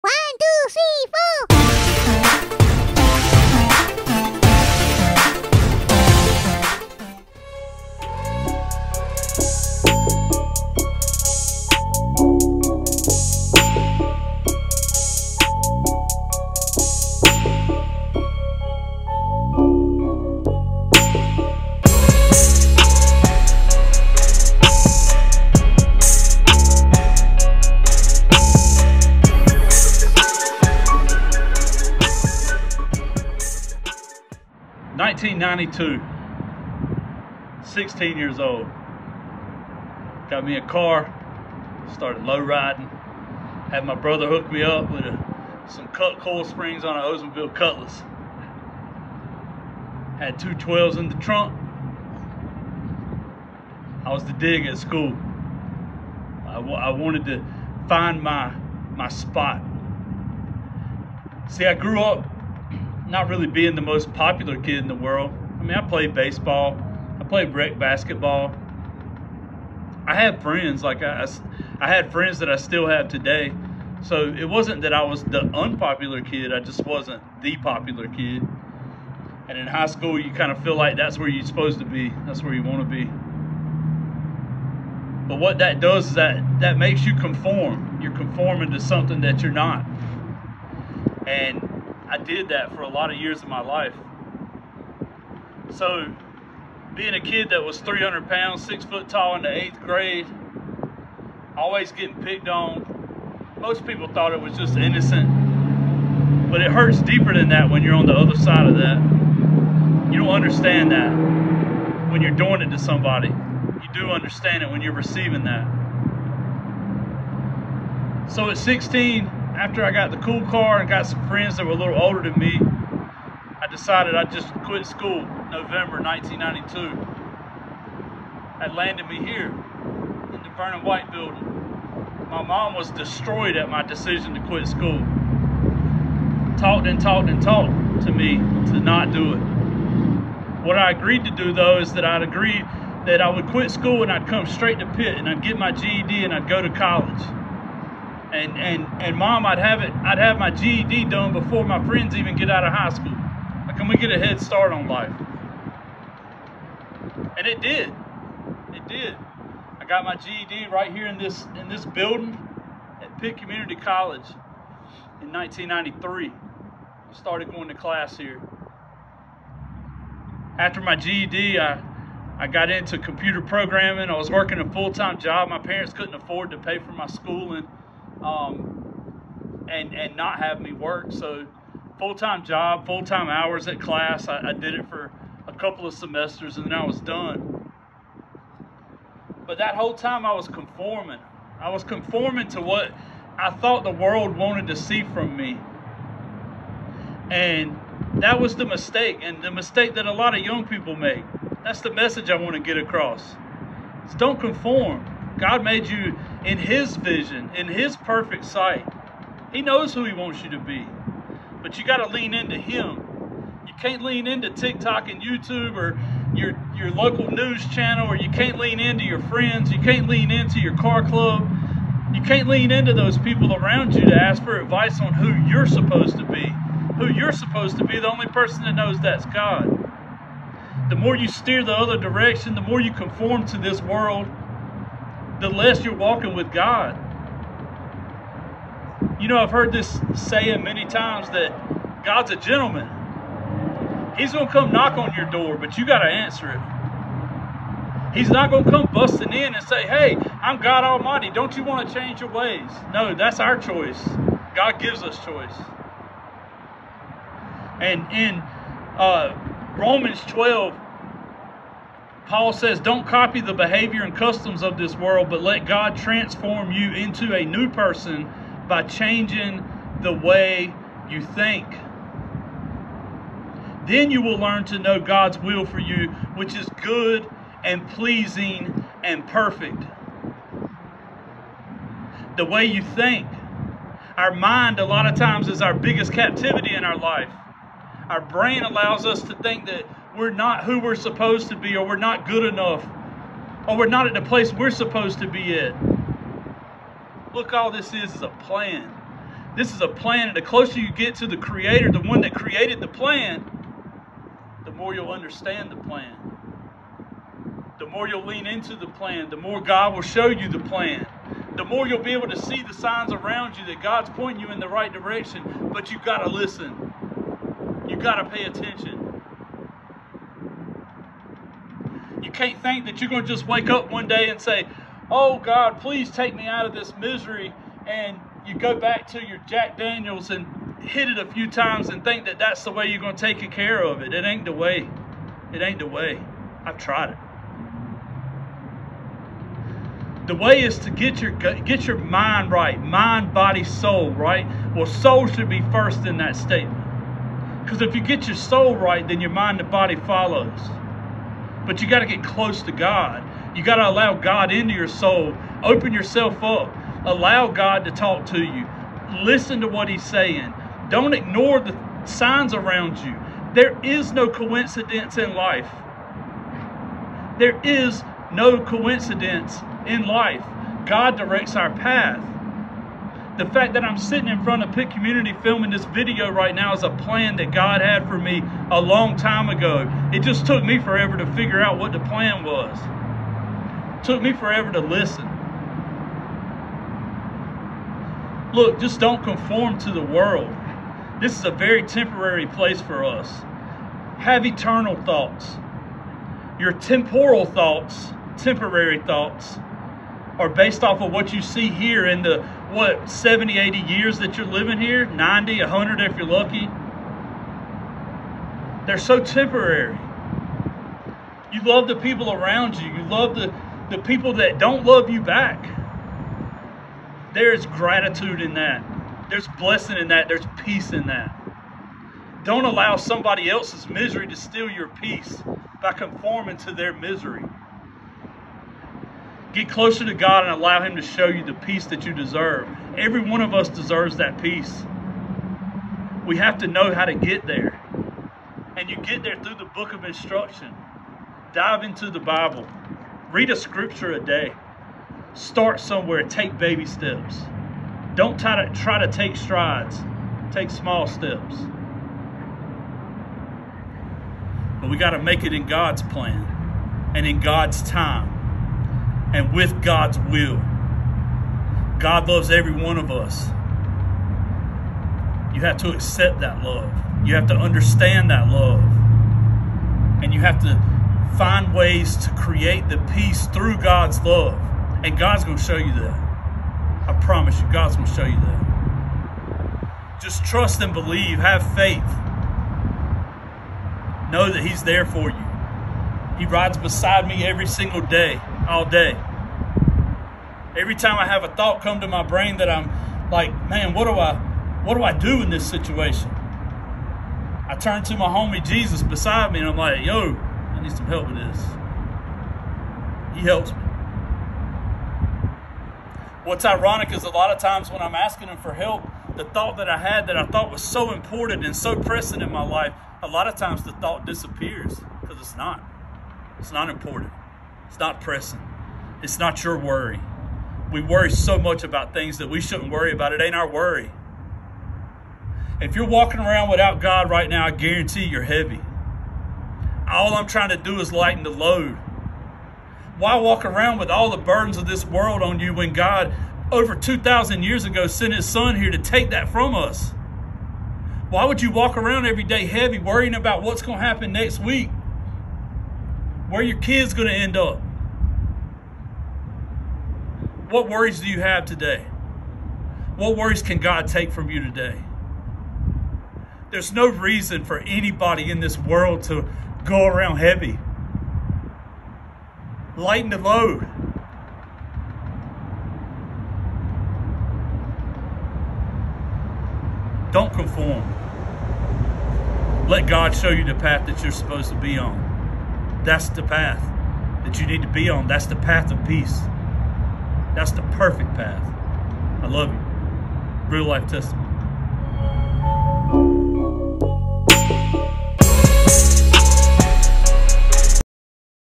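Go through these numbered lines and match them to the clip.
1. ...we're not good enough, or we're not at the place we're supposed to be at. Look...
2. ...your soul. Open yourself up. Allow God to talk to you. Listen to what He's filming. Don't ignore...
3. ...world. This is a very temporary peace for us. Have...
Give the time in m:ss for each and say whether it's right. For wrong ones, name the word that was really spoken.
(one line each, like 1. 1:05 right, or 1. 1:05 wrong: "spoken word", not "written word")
1. 4:51 right
2. 5:54 wrong: "saying", not "filming"
3. 6:30 wrong: "place", not "peace".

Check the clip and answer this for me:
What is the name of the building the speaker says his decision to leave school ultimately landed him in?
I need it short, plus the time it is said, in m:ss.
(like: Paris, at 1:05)
Vernon White building, at 2:10.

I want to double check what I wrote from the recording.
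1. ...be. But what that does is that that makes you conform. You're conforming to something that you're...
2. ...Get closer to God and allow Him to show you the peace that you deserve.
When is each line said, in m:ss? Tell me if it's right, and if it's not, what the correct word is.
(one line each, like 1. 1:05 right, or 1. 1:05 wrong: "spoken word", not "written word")
1. 1:22 right
2. 7:09 right.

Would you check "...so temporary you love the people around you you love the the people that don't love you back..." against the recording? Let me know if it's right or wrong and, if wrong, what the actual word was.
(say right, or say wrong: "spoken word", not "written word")
right.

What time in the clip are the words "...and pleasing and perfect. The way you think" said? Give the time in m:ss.
4:37.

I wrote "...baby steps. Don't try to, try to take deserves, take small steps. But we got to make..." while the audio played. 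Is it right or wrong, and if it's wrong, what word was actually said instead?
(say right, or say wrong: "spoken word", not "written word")
wrong: "strides", not "deserves".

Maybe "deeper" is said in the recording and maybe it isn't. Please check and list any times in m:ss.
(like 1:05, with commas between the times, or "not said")
1:47.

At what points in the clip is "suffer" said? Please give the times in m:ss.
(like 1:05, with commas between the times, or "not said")
not said.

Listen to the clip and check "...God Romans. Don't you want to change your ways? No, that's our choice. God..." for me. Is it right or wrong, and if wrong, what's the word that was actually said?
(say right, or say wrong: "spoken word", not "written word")
wrong: "Almighty", not "Romans".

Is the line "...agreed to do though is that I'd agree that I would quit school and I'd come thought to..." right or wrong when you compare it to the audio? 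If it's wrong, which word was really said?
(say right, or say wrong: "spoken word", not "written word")
wrong: "straight", not "thought".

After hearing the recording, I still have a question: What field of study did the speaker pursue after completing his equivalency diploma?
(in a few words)
Computer programming.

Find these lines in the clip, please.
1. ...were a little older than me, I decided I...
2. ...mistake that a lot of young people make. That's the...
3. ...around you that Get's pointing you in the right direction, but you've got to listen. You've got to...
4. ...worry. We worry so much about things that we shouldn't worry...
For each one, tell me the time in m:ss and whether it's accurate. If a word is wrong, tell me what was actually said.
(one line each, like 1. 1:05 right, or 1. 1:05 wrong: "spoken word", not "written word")
1. 2:01 right
2. 3:19 right
3. 5:13 wrong: "God", not "Get"
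4. 8:39 right.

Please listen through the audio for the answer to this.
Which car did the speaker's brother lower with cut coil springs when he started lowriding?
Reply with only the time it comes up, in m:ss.
0:47.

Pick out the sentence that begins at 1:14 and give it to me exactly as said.
So it wasn't that I was the unpopular kid.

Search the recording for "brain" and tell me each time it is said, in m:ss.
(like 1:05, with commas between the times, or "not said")
4:48, 8:12.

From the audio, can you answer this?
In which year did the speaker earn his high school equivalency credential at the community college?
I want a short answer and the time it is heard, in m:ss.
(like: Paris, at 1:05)
1993, at 2:45.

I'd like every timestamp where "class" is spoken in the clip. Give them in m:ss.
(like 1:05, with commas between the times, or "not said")
2:47, 3:03.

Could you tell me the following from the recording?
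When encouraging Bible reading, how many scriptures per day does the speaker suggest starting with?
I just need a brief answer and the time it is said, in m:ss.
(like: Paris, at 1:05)
1, at 7:23.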